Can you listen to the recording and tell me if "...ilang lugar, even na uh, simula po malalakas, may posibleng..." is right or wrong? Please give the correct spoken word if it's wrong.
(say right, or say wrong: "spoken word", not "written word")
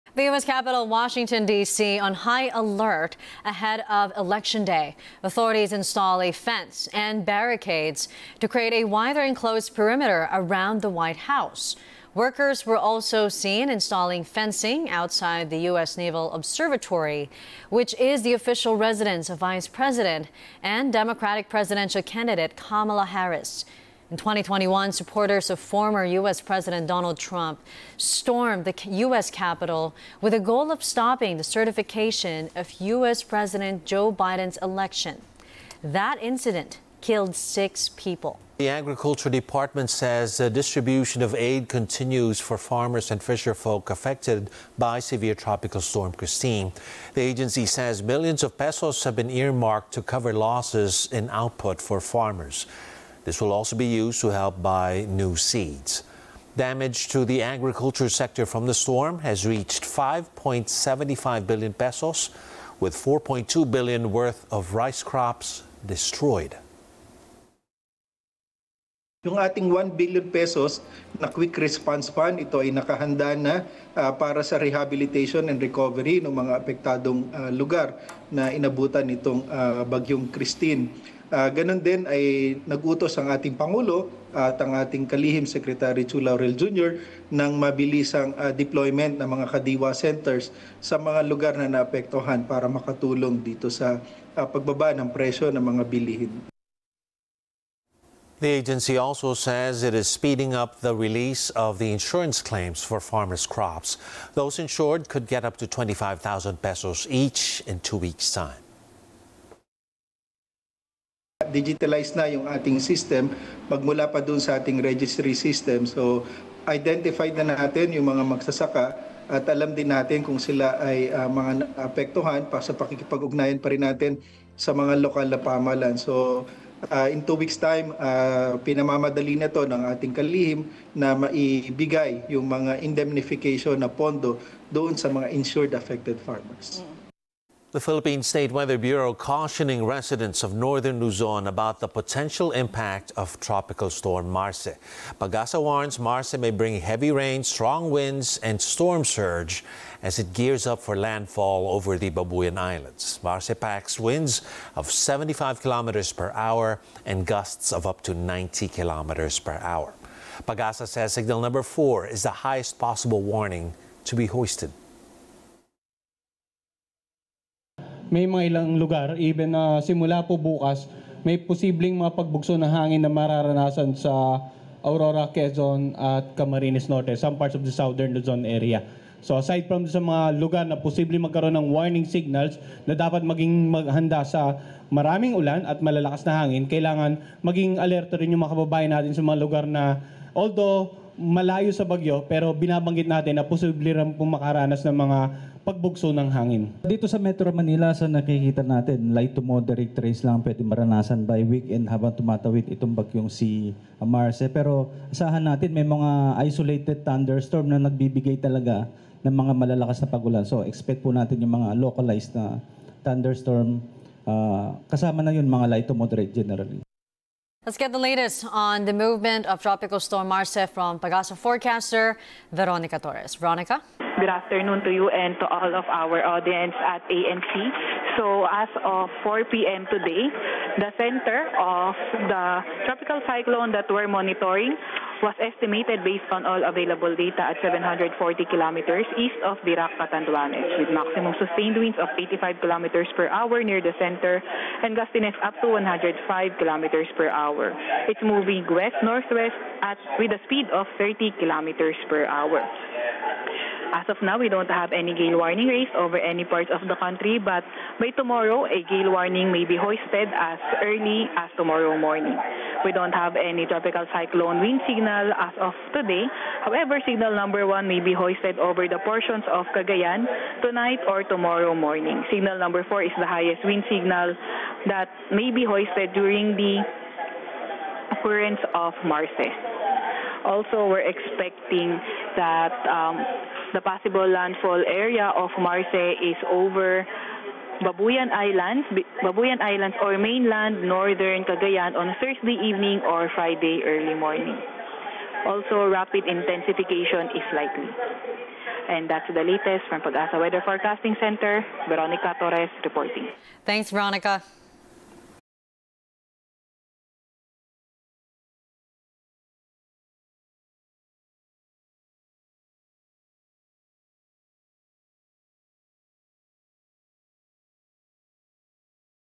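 wrong: "bukas", not "malalakas".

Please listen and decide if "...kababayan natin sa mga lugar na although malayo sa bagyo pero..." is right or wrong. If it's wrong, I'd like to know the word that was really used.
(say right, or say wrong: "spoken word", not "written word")
right.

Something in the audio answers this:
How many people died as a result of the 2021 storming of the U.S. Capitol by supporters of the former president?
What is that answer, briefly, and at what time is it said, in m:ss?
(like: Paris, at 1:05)
6, at 0:37.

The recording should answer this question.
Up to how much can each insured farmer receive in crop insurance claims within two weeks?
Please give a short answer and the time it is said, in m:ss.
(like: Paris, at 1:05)
25,000 pesos, at 1:45.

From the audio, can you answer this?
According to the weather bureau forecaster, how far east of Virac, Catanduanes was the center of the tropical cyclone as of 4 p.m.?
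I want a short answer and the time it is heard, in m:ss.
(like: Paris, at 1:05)
740 kilometers, at 3:57.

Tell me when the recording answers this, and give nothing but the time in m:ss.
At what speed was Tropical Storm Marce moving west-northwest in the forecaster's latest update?
4:11.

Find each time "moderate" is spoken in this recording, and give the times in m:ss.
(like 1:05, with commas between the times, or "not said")
3:19, 3:35.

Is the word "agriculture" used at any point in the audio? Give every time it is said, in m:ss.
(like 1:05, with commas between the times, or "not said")
0:38, 0:57.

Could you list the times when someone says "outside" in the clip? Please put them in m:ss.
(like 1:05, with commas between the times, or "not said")
0:14.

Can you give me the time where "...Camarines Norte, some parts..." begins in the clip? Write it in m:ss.
2:56.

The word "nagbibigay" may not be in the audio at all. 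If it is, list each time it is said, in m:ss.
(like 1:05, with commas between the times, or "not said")
3:27.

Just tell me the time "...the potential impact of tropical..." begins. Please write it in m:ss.
2:21.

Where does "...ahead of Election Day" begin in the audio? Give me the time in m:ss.
0:03.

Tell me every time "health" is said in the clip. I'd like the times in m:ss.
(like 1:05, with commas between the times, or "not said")
not said.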